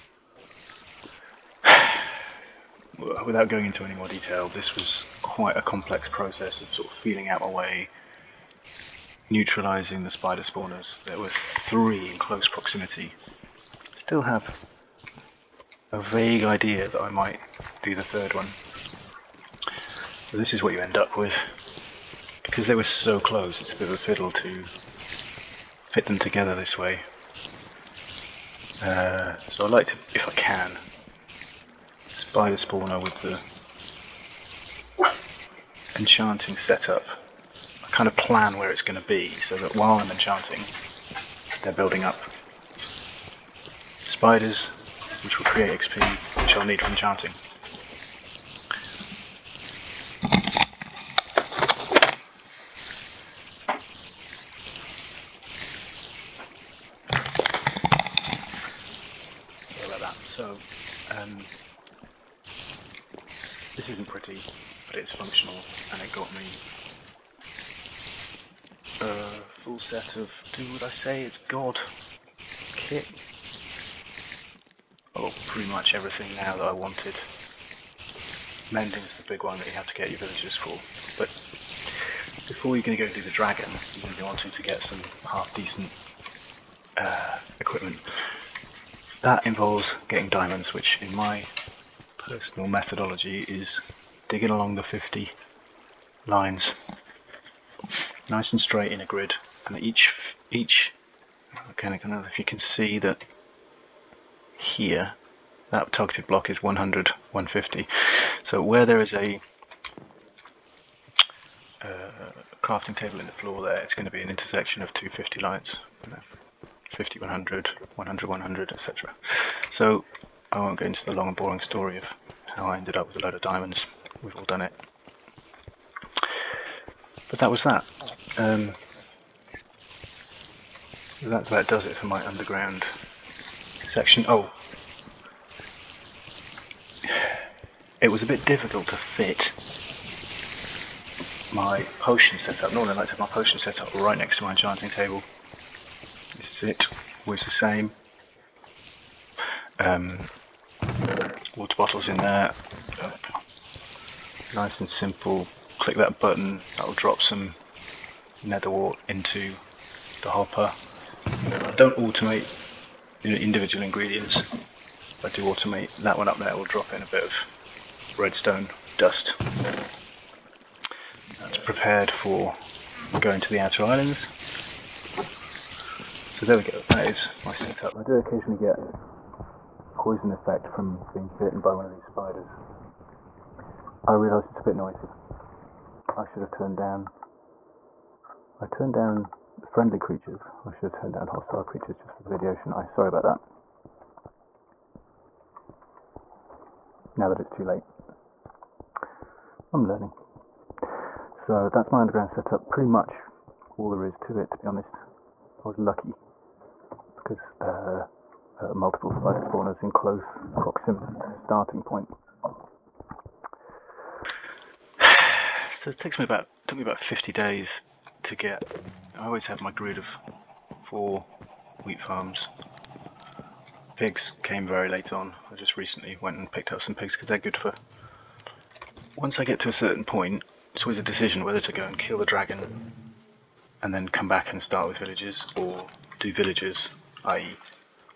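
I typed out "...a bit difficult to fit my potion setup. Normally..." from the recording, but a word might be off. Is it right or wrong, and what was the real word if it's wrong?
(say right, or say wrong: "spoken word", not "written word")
right.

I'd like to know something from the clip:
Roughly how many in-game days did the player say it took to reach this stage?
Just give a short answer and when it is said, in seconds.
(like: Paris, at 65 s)
50, at 216 s.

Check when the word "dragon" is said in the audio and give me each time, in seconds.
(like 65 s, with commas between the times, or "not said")
83 s, 232 s.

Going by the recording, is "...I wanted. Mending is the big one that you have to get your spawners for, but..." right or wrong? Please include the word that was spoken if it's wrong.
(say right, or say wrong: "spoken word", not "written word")
wrong: "villagers", not "spawners".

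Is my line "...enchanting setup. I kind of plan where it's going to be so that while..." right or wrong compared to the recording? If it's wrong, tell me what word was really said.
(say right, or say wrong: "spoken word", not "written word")
right.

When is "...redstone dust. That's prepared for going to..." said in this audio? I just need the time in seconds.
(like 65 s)
168 s.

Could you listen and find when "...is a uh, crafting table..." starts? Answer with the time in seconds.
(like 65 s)
109 s.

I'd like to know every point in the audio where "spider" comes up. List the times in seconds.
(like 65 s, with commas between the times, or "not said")
10 s, 32 s, 42 s, 182 s, 209 s.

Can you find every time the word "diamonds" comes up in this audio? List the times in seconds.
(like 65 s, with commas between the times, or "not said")
90 s, 123 s.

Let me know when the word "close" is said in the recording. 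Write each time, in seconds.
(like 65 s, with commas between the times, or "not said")
12 s, 23 s, 209 s.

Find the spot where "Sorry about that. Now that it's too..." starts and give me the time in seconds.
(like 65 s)
192 s.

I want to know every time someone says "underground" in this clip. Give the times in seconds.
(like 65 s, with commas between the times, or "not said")
132 s, 201 s.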